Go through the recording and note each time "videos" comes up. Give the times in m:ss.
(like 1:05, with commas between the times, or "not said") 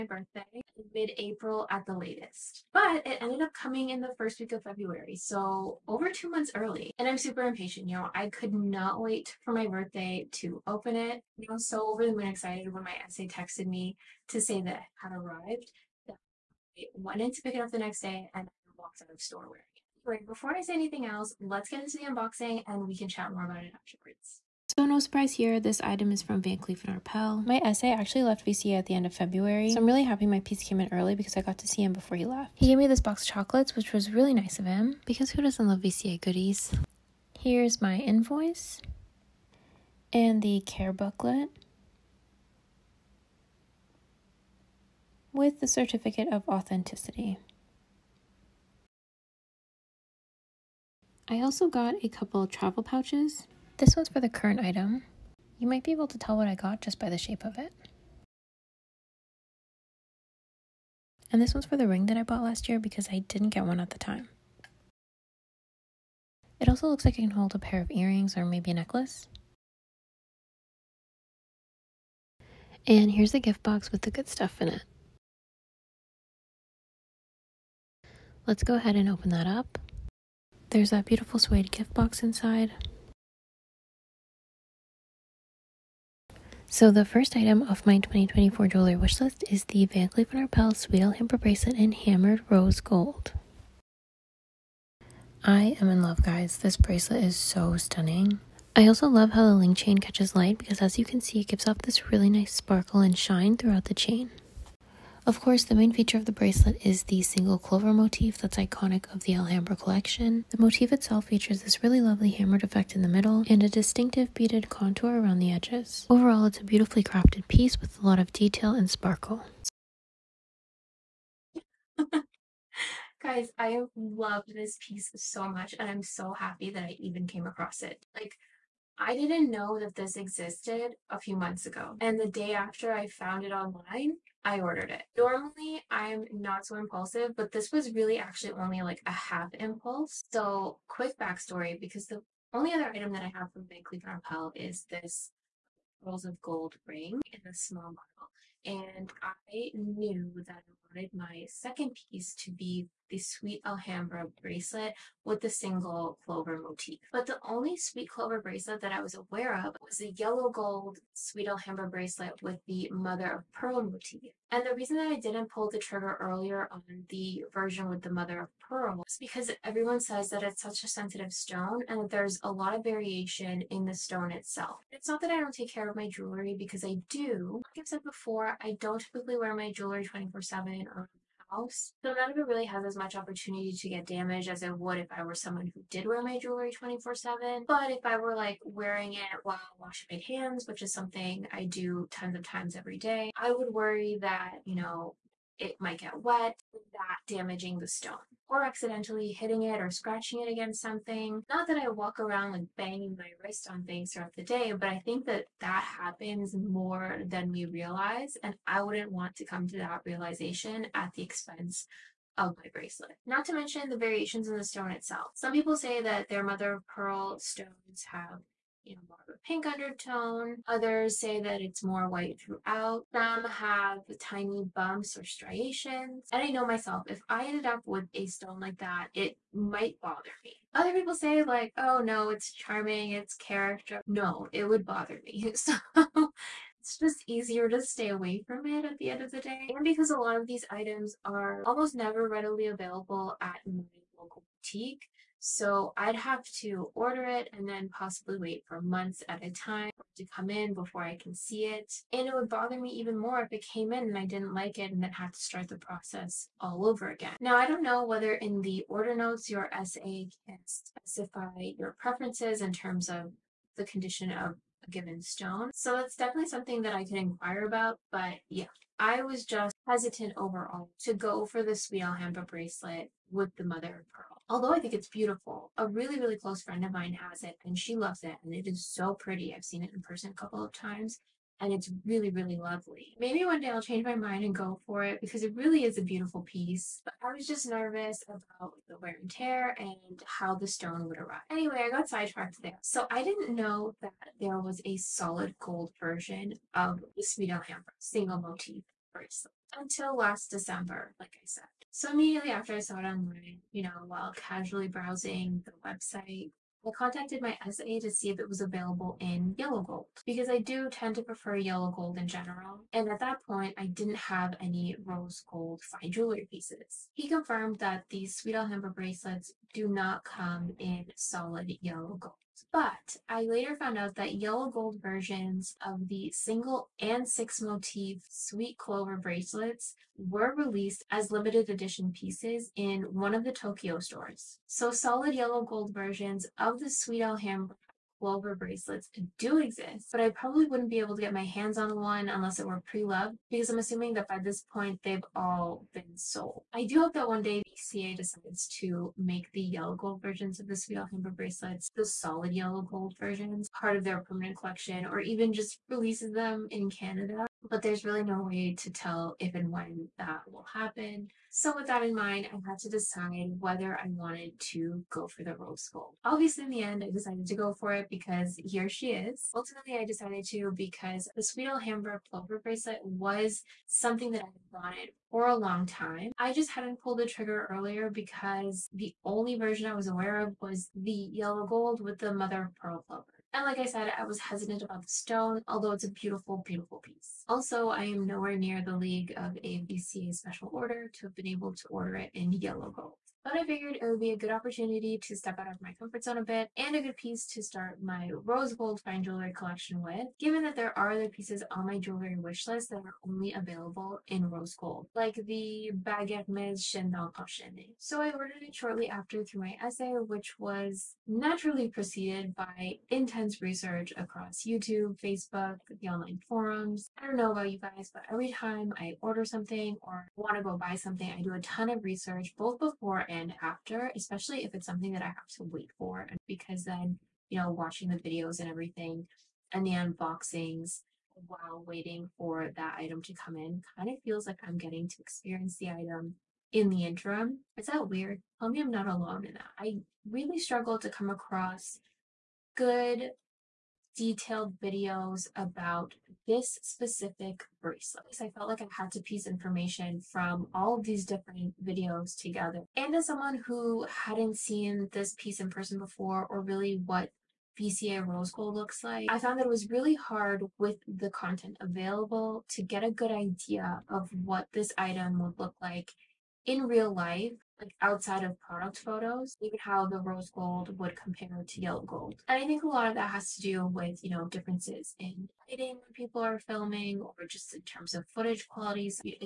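7:08, 7:24, 7:31.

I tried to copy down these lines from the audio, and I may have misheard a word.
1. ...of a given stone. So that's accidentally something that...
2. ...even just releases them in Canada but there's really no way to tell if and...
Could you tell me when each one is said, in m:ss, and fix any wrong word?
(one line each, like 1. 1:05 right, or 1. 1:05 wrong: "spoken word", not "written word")
1. 4:24 wrong: "definitely", not "accidentally"
2. 5:55 right.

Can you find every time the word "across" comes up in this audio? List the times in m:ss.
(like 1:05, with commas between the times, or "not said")
2:07, 6:54, 7:21.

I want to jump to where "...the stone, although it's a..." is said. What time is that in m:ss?
6:25.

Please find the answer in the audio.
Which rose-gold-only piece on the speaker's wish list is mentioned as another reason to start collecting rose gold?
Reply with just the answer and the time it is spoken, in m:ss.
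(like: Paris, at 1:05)
Baguette Mez Chandon Enchaîné, at 6:46.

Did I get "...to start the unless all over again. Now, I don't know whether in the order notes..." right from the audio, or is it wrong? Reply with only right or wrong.
wrong.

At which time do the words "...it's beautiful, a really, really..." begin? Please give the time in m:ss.
4:34.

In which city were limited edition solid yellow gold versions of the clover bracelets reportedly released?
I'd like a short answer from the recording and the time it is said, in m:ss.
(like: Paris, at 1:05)
Tokyo, at 5:33.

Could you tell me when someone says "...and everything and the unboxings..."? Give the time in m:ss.
7:08.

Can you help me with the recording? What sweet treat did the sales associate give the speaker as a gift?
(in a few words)
box of chocolates.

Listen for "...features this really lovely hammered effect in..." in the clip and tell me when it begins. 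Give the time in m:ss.
1:51.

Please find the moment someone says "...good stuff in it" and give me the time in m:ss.
1:14.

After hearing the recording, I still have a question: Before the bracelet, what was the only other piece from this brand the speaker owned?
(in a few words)
Pearls of Gold ring.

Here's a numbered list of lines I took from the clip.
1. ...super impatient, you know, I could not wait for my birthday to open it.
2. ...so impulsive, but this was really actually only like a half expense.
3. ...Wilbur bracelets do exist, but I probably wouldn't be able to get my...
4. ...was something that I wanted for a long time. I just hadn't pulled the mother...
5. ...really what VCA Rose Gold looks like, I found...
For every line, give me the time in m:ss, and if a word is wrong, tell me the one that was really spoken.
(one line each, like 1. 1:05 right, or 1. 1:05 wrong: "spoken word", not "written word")
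1. 0:07 right
2. 2:16 wrong: "impulse", not "expense"
3. 5:38 right
4. 6:13 wrong: "trigger", not "mother"
5. 7:36 right.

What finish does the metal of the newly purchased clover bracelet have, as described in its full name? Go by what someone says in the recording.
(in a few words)
Hammered Rose Gold.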